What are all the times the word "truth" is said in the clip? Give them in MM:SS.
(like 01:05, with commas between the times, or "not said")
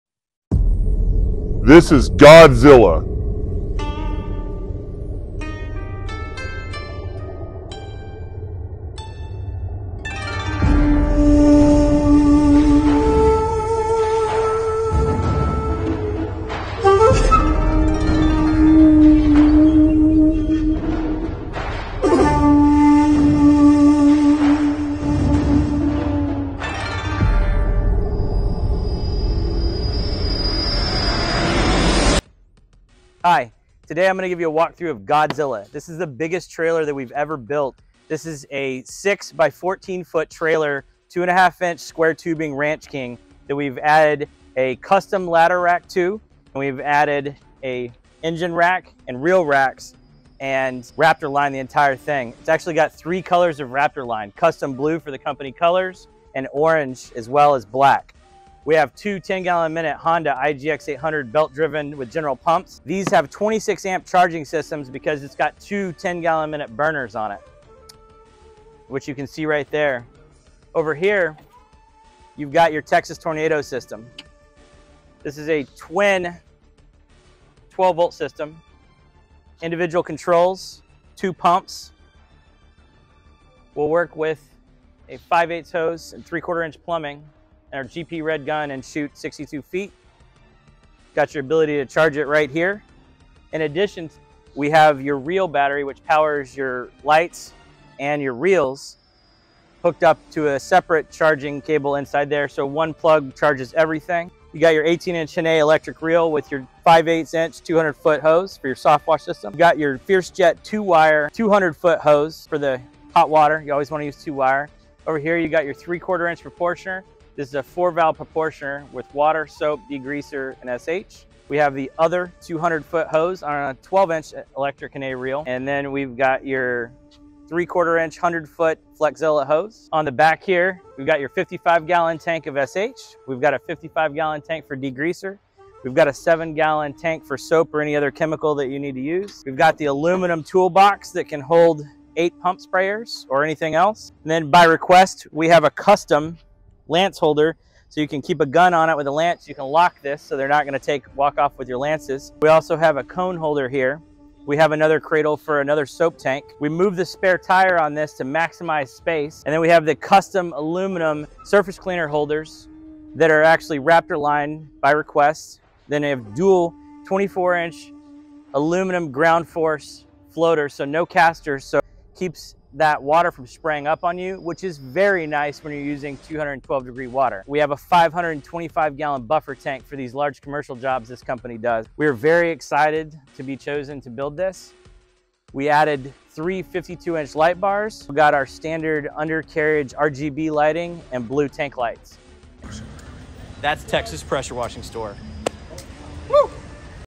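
not said.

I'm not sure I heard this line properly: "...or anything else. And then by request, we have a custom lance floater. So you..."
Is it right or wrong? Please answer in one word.
wrong.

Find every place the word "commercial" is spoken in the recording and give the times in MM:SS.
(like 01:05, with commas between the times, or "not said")
03:00.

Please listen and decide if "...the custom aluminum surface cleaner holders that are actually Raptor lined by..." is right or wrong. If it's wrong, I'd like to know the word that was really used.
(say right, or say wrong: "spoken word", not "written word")
right.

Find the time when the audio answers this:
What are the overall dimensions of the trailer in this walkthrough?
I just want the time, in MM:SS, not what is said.
00:38.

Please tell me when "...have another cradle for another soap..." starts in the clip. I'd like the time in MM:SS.
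02:34.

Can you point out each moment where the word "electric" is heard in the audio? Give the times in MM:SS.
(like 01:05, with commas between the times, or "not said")
01:45, 02:04.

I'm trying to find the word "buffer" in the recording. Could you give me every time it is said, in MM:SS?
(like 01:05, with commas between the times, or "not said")
02:59.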